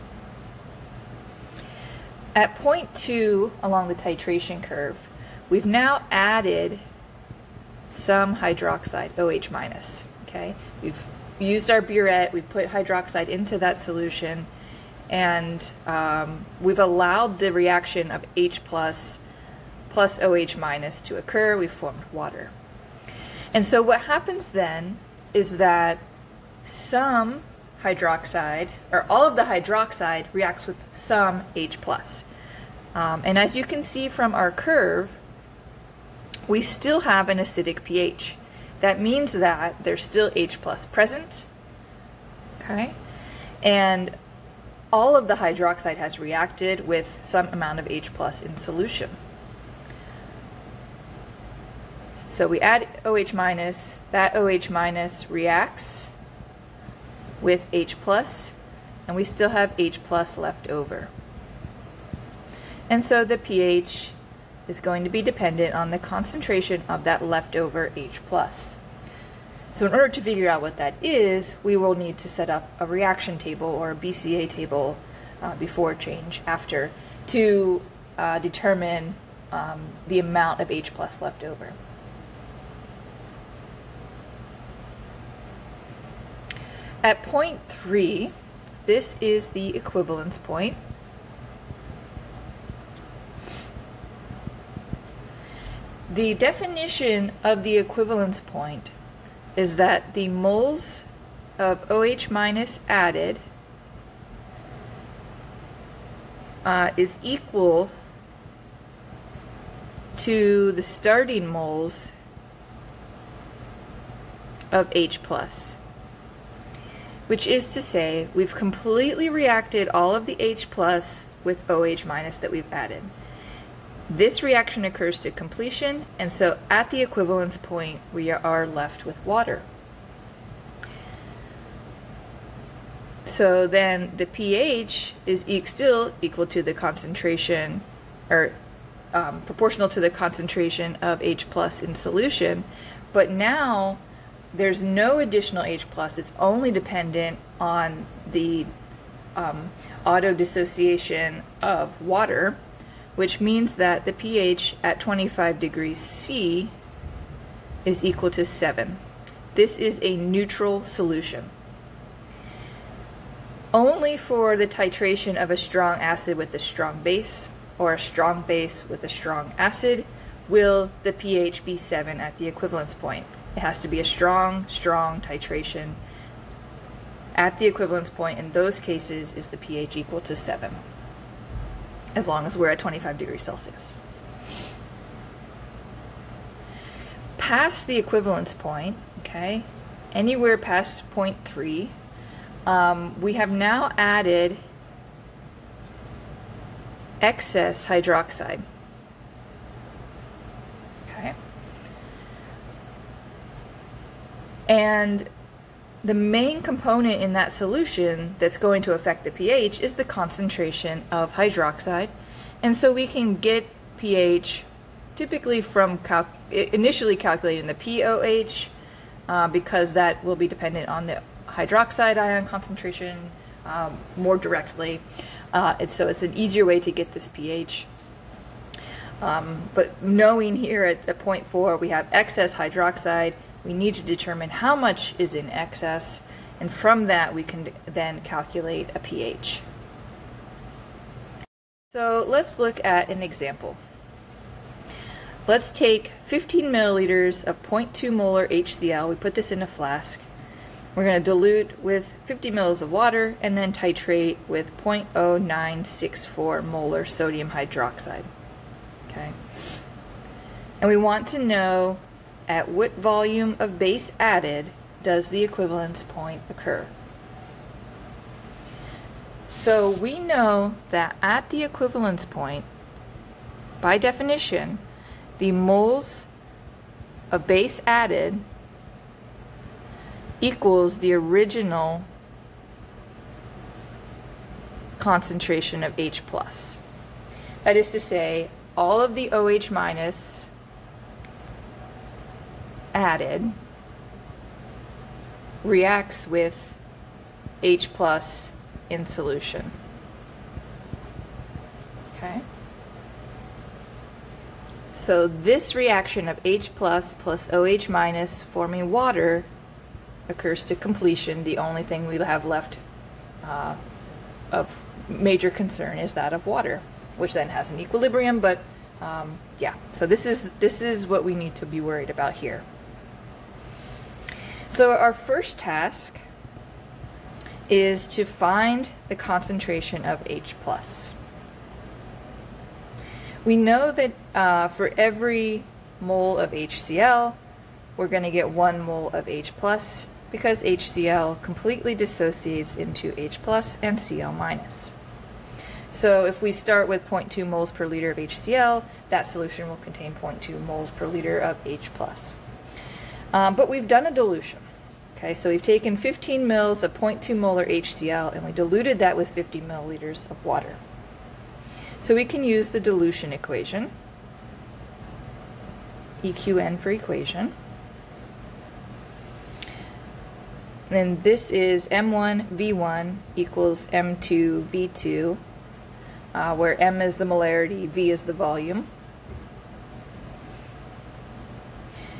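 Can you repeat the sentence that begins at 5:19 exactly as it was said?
So this is, this is what we need to be worried about here.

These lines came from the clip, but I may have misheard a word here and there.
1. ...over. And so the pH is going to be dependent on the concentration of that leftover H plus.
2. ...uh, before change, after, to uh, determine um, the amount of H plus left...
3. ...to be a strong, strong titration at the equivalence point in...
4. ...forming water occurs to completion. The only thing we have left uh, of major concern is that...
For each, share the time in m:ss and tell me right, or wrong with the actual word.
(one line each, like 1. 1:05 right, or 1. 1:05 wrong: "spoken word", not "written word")
1. 1:00 right
2. 1:15 right
3. 2:53 right
4. 5:08 right.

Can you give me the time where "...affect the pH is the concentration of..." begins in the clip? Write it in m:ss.
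3:28.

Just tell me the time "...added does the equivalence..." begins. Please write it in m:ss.
4:24.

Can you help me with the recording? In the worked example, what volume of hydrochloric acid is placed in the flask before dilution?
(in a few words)
15 mL.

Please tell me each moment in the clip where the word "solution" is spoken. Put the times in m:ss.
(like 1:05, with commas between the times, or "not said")
0:13, 0:48, 2:21, 2:40, 3:27, 4:59, 5:49.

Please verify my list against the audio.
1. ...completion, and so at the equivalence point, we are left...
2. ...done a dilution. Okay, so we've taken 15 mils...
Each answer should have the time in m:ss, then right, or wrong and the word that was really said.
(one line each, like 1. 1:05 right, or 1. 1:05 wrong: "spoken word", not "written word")
1. 2:05 right
2. 5:53 right.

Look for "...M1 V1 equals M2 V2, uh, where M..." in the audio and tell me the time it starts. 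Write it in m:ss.
6:11.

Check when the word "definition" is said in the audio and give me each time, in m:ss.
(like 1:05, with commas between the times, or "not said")
1:36, 4:33.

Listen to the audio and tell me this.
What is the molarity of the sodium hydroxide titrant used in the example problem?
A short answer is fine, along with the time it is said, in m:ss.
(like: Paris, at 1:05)
0.0964 M, at 4:14.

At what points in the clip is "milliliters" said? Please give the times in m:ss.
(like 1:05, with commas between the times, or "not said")
4:06, 5:59.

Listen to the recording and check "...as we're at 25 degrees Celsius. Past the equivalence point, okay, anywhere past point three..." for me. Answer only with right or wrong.
right.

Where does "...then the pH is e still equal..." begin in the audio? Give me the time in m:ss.
2:13.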